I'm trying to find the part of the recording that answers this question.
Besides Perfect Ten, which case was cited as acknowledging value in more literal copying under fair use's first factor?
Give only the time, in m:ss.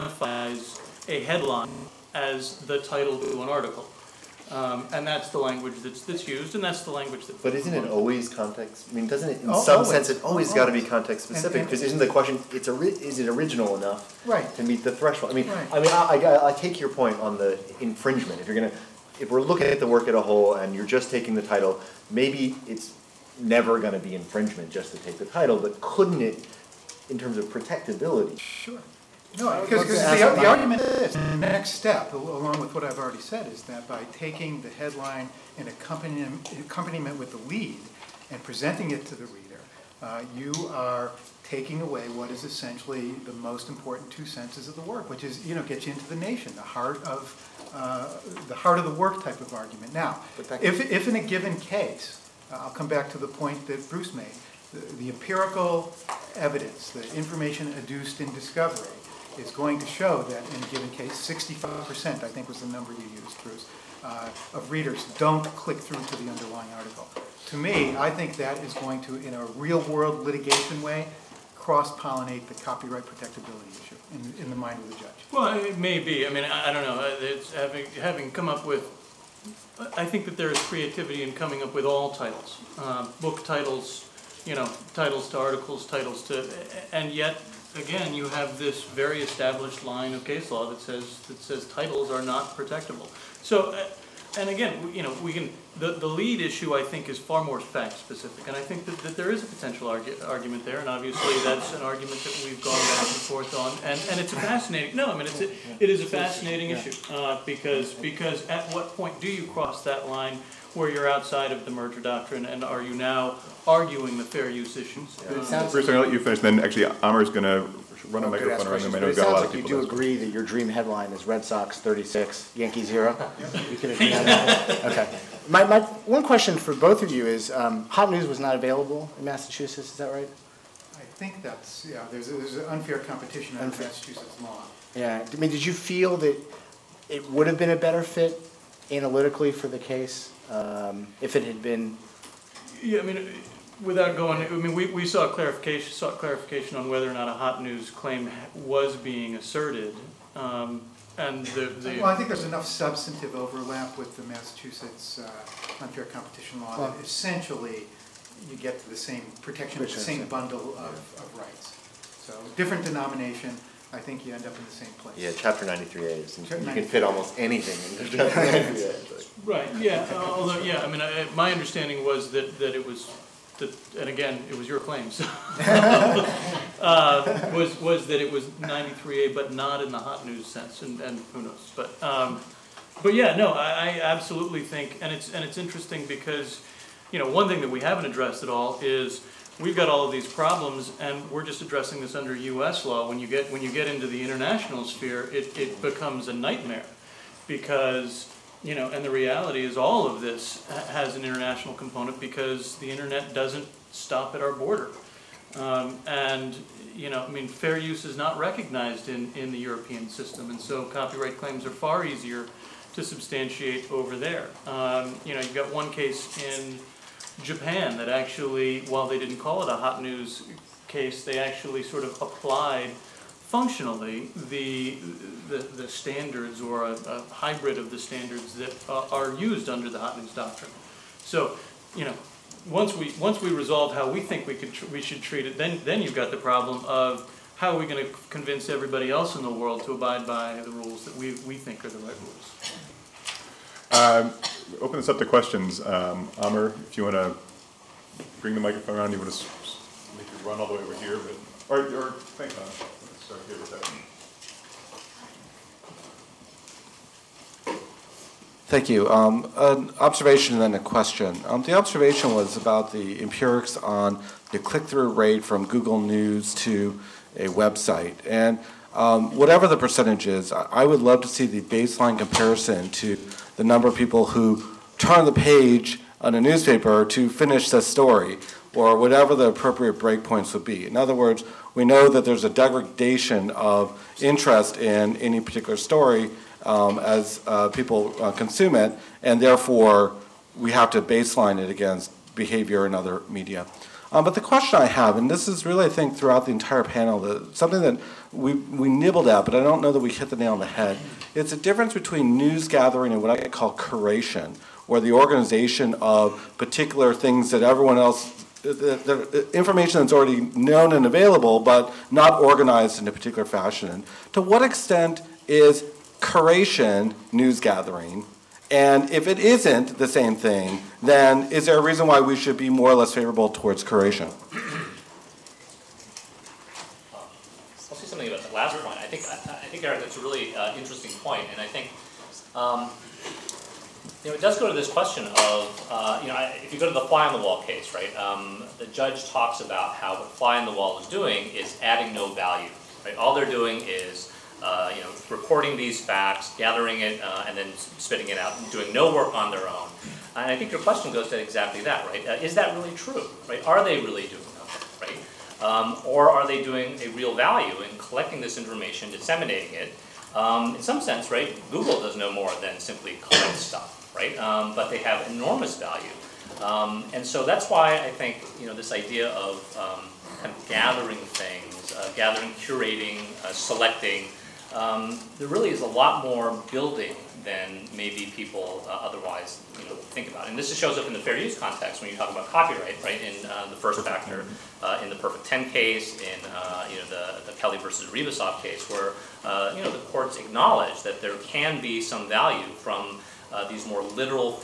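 6:27.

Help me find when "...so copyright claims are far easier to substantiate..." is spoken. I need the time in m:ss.
3:30.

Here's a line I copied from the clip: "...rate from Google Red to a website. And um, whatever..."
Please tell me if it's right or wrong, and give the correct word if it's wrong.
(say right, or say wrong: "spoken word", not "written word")
wrong: "News", not "Red".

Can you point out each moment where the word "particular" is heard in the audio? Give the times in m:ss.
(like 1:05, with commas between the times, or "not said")
4:45, 5:06, 5:13.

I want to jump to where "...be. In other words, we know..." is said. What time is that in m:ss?
4:40.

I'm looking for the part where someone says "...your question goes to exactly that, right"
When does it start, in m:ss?
5:50.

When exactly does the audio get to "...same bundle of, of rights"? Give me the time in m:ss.
2:39.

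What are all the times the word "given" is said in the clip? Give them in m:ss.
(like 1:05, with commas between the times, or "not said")
0:51, 1:00.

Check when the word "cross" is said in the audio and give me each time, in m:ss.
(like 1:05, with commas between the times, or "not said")
1:11, 1:49.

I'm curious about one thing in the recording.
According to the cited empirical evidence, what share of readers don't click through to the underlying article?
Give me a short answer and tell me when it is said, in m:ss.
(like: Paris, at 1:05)
65%, at 1:01.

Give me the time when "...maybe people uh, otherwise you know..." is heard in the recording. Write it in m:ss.
6:17.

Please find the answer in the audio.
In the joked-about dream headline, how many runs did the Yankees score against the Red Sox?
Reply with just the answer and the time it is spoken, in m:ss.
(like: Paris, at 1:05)
0, at 2:02.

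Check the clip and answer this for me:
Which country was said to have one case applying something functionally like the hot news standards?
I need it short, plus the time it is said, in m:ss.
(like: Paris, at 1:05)
Japan, at 3:37.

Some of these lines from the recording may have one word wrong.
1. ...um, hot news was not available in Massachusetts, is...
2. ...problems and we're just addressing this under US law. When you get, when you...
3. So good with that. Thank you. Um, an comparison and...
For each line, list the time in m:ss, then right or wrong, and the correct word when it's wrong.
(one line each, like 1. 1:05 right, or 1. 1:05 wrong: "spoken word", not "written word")
1. 2:07 right
2. 3:10 right
3. 4:13 wrong: "observation", not "comparison".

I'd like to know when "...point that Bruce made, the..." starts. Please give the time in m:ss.
0:53.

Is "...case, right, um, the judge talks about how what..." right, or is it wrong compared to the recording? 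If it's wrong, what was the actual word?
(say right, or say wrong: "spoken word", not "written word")
right.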